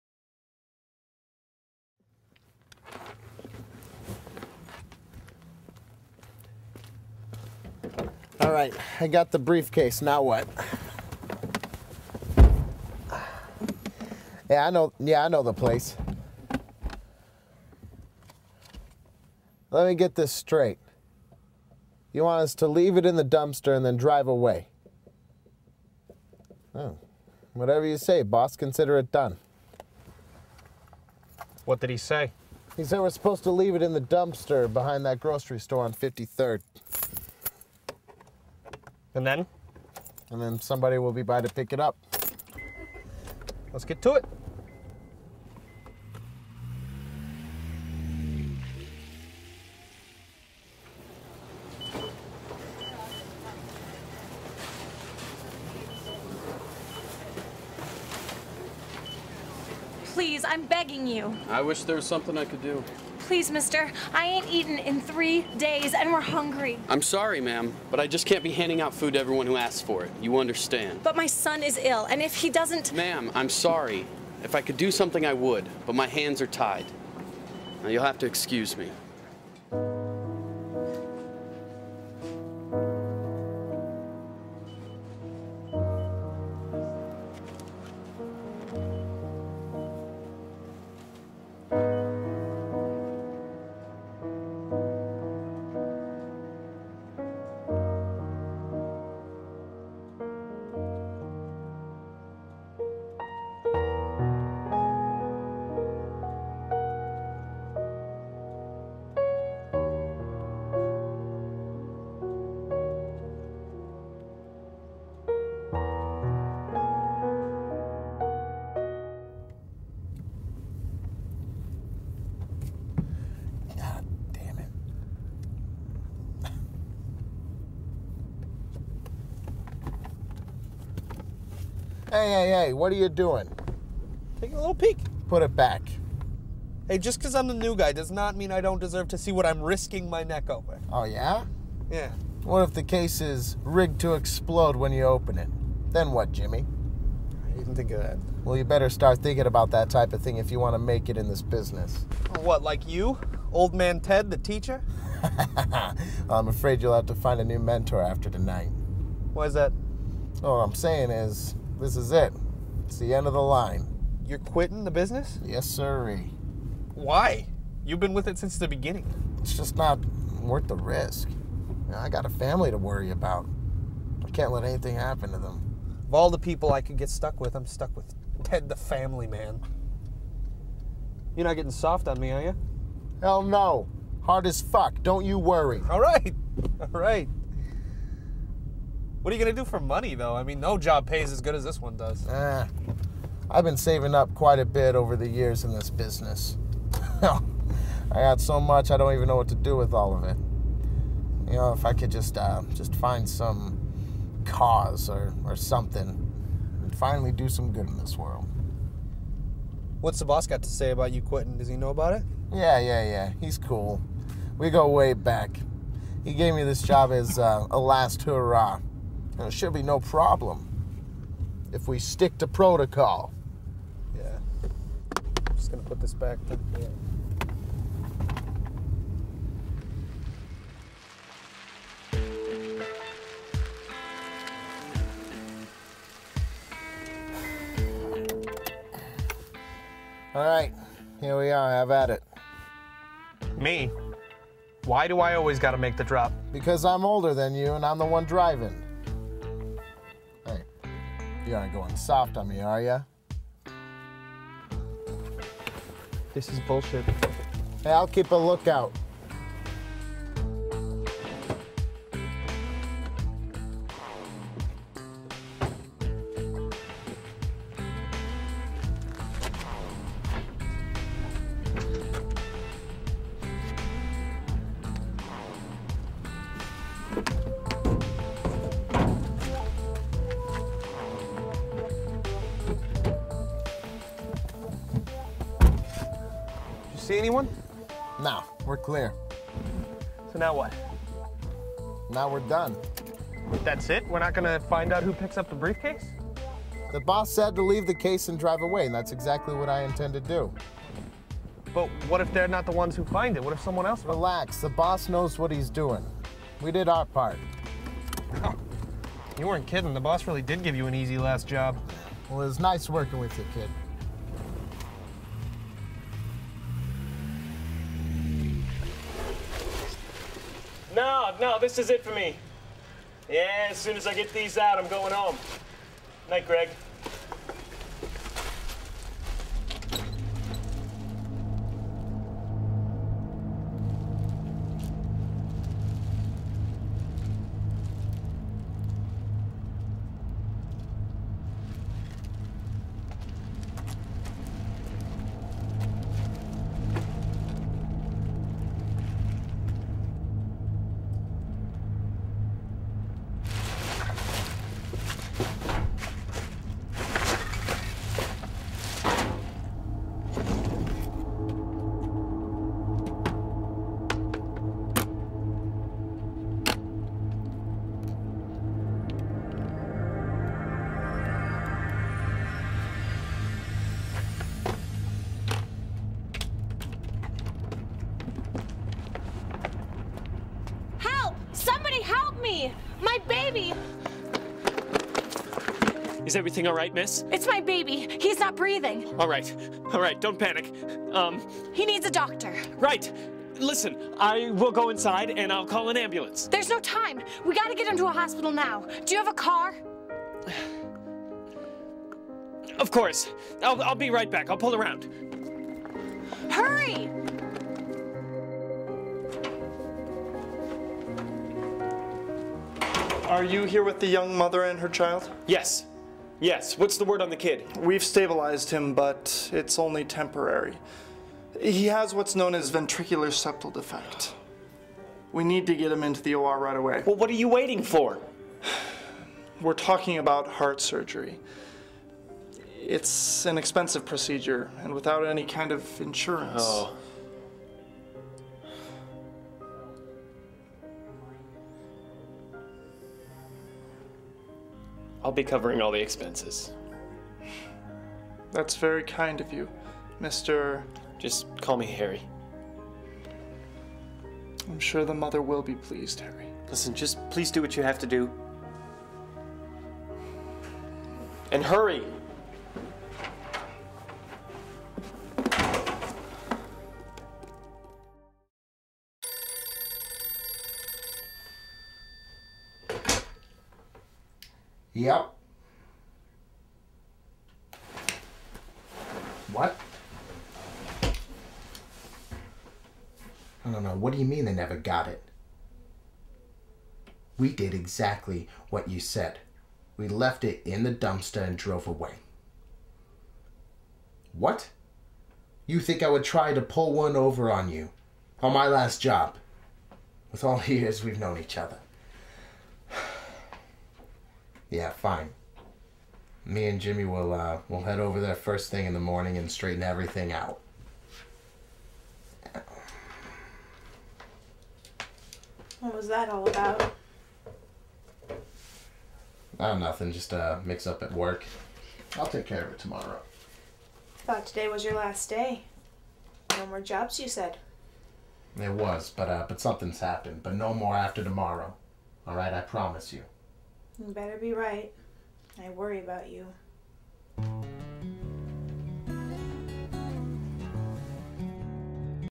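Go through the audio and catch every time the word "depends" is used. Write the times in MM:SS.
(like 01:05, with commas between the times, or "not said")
not said.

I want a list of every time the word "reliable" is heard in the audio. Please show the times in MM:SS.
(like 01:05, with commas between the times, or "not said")
not said.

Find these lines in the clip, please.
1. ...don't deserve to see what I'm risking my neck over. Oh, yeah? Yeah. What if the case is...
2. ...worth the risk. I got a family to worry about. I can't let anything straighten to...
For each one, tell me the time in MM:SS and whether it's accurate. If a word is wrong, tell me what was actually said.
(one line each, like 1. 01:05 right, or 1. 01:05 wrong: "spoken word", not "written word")
1. 02:18 right
2. 02:50 wrong: "happen", not "straighten".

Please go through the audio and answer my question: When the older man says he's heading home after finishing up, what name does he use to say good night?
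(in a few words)
Greg.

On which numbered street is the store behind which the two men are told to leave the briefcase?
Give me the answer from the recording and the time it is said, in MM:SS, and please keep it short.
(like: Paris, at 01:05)
53rd, at 00:35.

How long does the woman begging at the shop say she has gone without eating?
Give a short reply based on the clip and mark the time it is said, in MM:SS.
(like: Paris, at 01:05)
3 days, at 01:04.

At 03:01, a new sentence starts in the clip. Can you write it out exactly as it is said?
You're not getting soft on me, are you?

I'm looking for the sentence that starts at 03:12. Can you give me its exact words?
Eh, I've been saving up quite a bit over the years in this business.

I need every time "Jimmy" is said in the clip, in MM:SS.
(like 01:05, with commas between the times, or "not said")
02:26, 08:26.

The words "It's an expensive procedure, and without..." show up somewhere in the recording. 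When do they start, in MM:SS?
07:12.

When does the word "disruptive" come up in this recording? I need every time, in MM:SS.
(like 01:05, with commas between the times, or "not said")
not said.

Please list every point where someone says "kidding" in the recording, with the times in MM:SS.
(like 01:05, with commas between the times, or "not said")
05:09.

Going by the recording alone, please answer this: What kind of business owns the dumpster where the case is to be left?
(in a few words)
grocery store.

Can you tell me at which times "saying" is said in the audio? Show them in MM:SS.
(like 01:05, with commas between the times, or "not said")
02:40.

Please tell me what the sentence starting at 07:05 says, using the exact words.
We need to get him into the OR right away.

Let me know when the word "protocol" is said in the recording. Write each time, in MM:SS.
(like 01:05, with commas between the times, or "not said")
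03:42.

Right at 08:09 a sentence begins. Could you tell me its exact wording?
We left it in the dumpster and drove away.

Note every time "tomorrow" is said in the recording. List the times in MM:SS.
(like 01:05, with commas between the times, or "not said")
08:42, 08:51.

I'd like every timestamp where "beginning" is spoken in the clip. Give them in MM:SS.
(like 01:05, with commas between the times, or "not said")
02:48.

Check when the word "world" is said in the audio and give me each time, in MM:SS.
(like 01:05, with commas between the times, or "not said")
03:28.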